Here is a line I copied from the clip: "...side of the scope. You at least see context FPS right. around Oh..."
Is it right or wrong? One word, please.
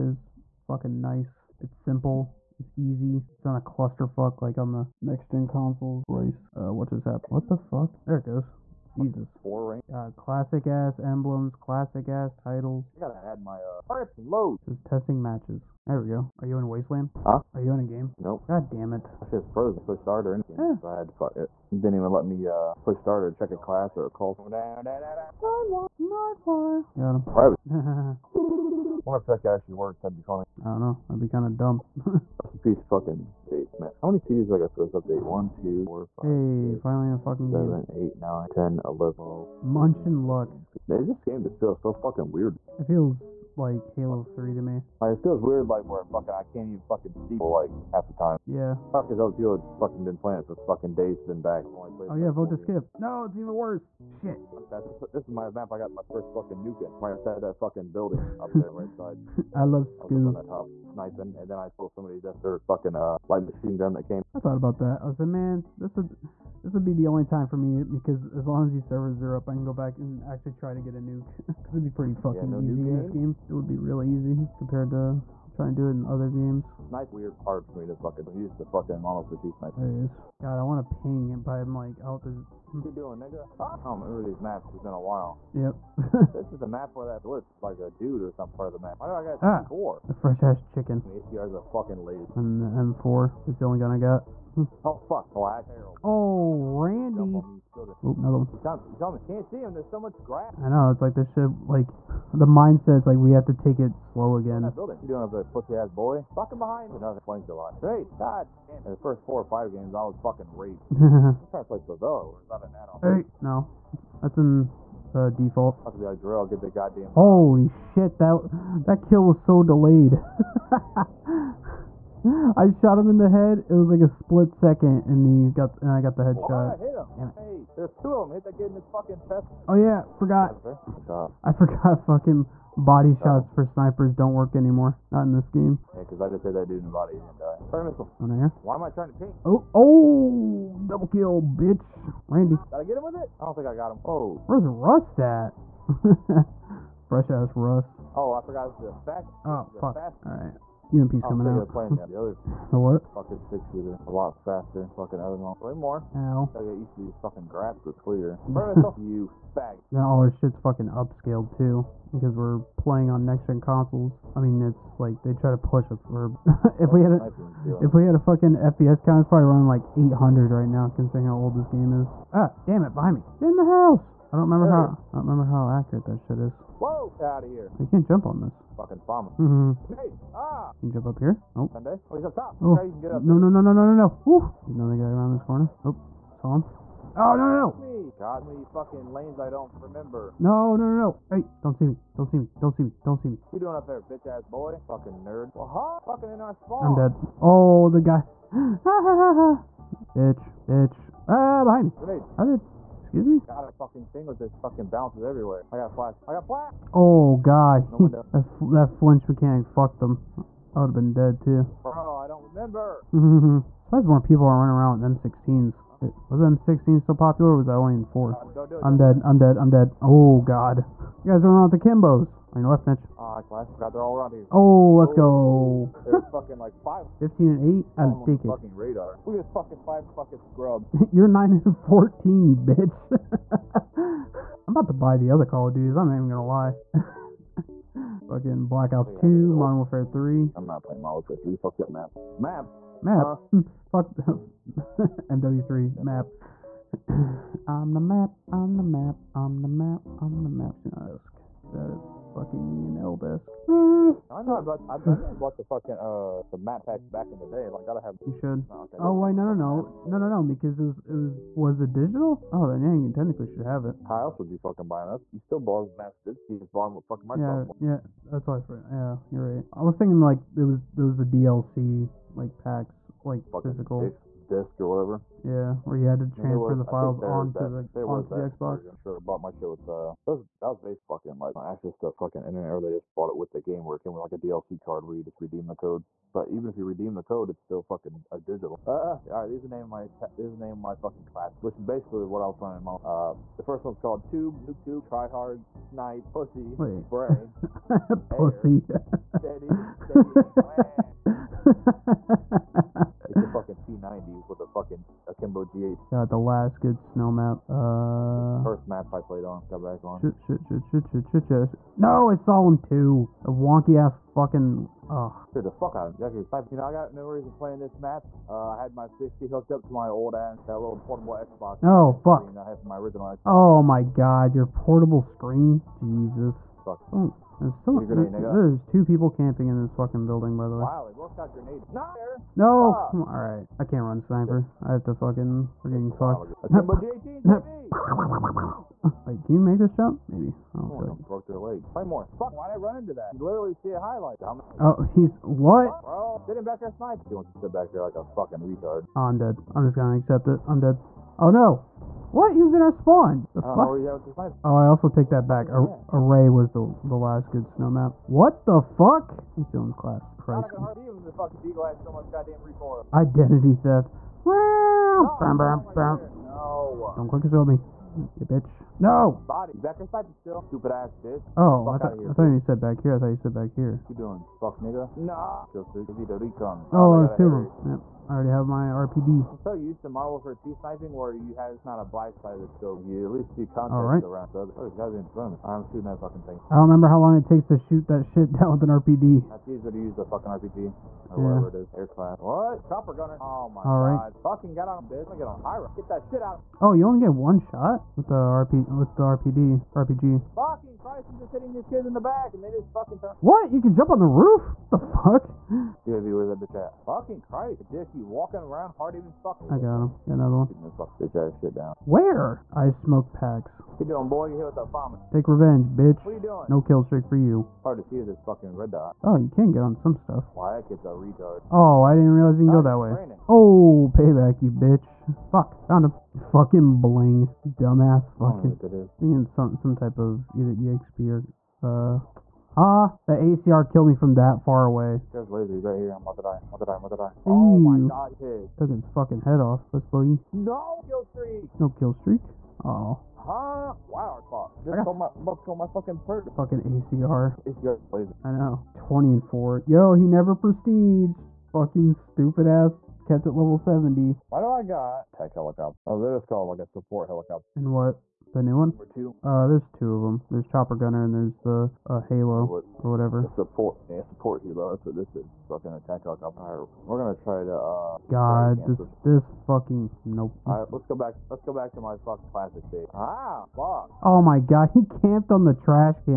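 wrong.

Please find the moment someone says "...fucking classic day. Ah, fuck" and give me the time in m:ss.
7:52.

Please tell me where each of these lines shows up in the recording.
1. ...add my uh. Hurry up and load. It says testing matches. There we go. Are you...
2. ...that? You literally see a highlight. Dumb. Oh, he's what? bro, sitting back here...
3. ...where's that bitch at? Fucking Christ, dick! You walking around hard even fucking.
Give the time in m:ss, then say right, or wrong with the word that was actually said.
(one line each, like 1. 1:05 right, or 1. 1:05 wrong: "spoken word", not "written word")
1. 0:13 right
2. 5:43 right
3. 6:46 right.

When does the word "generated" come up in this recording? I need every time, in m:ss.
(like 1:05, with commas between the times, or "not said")
not said.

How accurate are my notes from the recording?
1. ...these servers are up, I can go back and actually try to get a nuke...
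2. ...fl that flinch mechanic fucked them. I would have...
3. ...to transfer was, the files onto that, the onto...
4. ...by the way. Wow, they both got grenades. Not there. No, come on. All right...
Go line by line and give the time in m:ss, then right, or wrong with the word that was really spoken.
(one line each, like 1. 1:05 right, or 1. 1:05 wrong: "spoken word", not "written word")
1. 1:08 right
2. 3:28 right
3. 4:36 right
4. 5:30 right.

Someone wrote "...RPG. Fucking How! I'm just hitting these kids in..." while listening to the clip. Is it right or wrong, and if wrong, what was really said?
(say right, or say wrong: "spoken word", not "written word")
wrong: "Christ", not "How".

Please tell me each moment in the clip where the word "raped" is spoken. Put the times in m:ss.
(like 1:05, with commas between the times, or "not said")
1:50.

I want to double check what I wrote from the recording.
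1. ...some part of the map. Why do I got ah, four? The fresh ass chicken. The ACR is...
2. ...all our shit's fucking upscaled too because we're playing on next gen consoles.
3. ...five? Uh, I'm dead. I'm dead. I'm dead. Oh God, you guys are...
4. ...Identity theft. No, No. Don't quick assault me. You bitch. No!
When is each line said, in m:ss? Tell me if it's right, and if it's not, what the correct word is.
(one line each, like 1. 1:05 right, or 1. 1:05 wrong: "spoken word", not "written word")
1. 1:28 right
2. 2:40 right
3. 3:38 wrong: "four", not "five"
4. 6:03 right.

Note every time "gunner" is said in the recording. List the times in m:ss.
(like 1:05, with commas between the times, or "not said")
6:33, 7:40.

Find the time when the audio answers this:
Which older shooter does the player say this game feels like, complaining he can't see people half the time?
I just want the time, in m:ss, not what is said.
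0:43.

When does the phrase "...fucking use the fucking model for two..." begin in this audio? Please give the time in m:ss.
1:17.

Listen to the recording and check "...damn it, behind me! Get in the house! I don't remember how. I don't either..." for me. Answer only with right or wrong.
wrong.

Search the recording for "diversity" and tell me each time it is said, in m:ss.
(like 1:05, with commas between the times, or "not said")
not said.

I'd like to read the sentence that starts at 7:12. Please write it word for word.
Ah, the ACR killed me from that far away.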